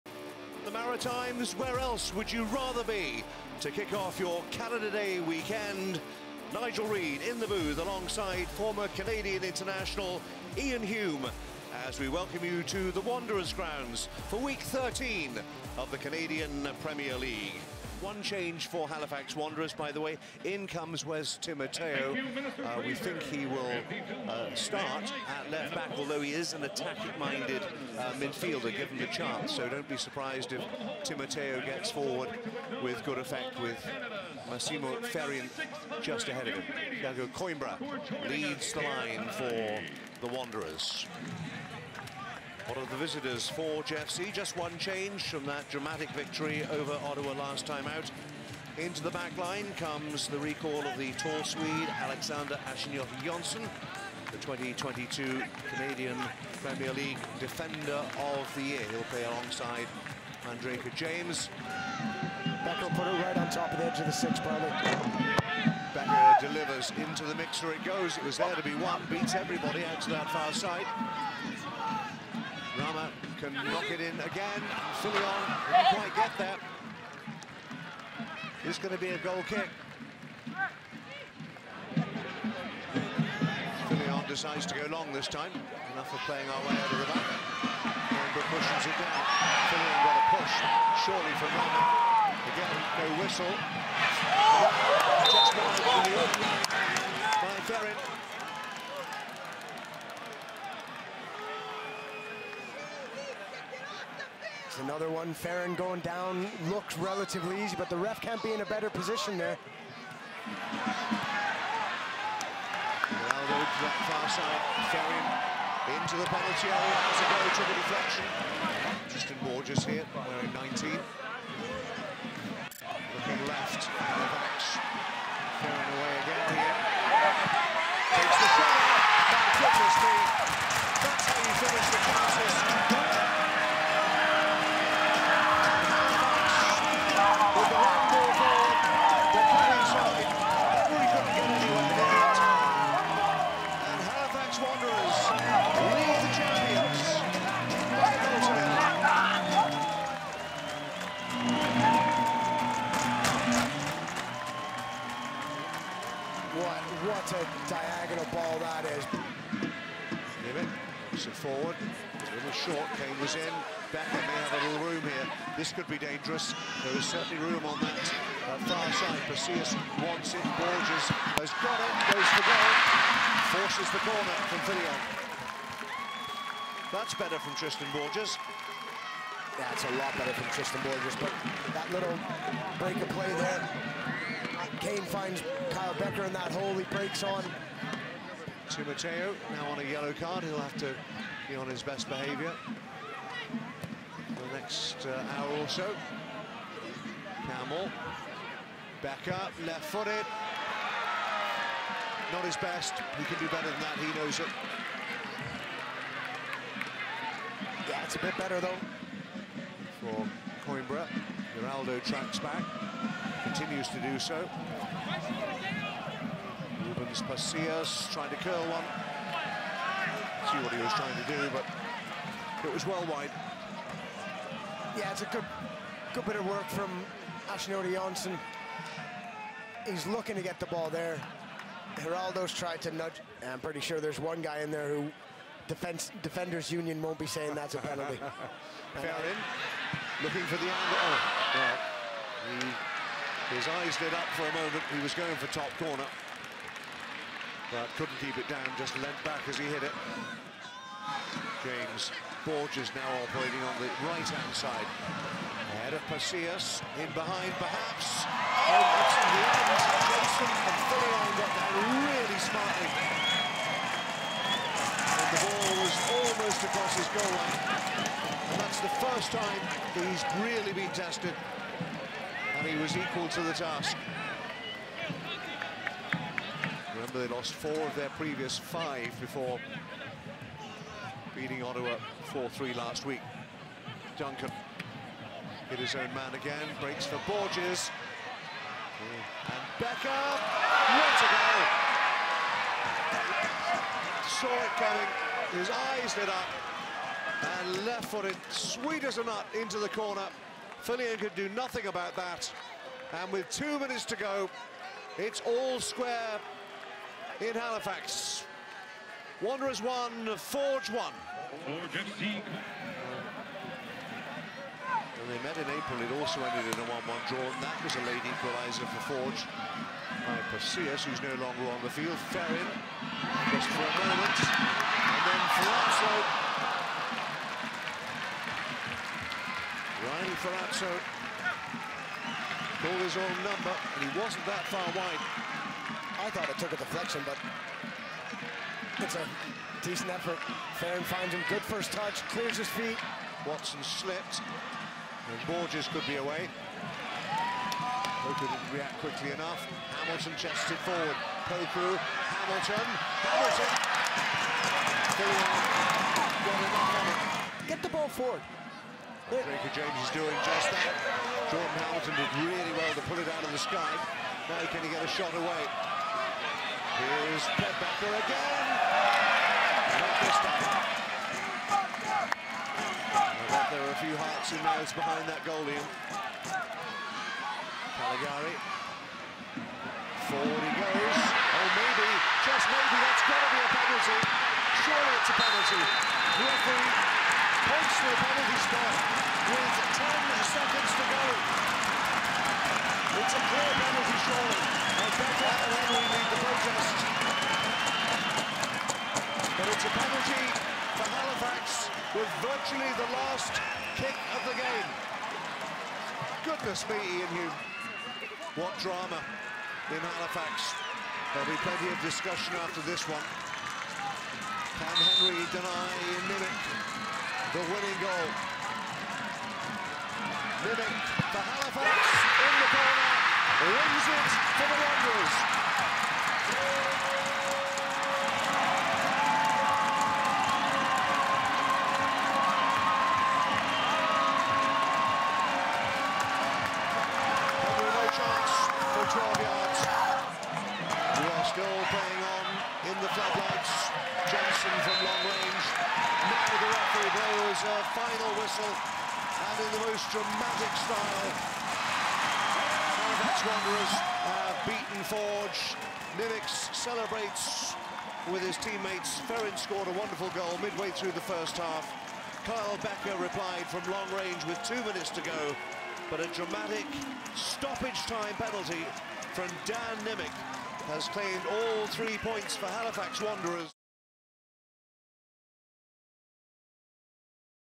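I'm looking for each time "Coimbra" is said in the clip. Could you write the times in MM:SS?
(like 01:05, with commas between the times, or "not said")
00:37, 03:30.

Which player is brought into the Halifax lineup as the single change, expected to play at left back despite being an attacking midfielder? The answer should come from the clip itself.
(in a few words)
Wes Timoteo.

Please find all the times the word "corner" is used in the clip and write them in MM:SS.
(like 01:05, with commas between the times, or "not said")
02:54, 04:05, 04:59, 07:02.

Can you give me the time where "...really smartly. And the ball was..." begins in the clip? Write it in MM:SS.
04:22.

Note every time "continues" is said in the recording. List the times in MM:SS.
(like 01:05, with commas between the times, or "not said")
03:33.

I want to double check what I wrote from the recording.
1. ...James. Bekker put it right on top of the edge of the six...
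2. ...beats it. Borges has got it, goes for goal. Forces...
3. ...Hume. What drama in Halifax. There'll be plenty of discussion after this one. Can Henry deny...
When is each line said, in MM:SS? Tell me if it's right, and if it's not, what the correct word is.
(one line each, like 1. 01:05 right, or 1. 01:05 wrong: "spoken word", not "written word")
1. 01:00 right
2. 02:50 wrong: "wants", not "beats"
3. 06:47 right.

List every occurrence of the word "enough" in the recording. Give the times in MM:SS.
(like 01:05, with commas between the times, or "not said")
01:25, 05:49.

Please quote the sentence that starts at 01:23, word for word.
Fillion decides to go long this time.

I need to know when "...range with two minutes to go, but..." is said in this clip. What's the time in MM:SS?
07:44.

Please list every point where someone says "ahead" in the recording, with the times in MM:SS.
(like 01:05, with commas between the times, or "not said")
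00:36, 04:15.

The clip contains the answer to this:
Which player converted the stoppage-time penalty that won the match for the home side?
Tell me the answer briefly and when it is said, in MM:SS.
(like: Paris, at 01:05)
Dan Nimick, at 07:49.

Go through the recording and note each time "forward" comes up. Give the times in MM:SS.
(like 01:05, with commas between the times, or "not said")
00:31, 02:41, 05:50, 05:58, 06:20.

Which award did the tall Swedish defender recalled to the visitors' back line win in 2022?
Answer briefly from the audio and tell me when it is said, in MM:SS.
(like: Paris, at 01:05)
Canadian Premier League Defender of the Year, at 00:55.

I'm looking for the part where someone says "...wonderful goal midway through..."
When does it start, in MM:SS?
07:39.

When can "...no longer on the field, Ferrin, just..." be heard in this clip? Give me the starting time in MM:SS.
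05:21.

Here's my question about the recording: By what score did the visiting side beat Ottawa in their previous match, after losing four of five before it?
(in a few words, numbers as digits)
4-3.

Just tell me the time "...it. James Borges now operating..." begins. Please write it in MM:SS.
04:09.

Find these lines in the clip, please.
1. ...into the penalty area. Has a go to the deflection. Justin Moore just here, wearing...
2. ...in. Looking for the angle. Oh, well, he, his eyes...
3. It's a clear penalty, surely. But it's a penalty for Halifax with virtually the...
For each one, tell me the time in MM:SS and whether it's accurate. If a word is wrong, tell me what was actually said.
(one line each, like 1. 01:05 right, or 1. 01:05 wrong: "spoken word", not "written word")
1. 01:56 right
2. 03:59 right
3. 06:33 right.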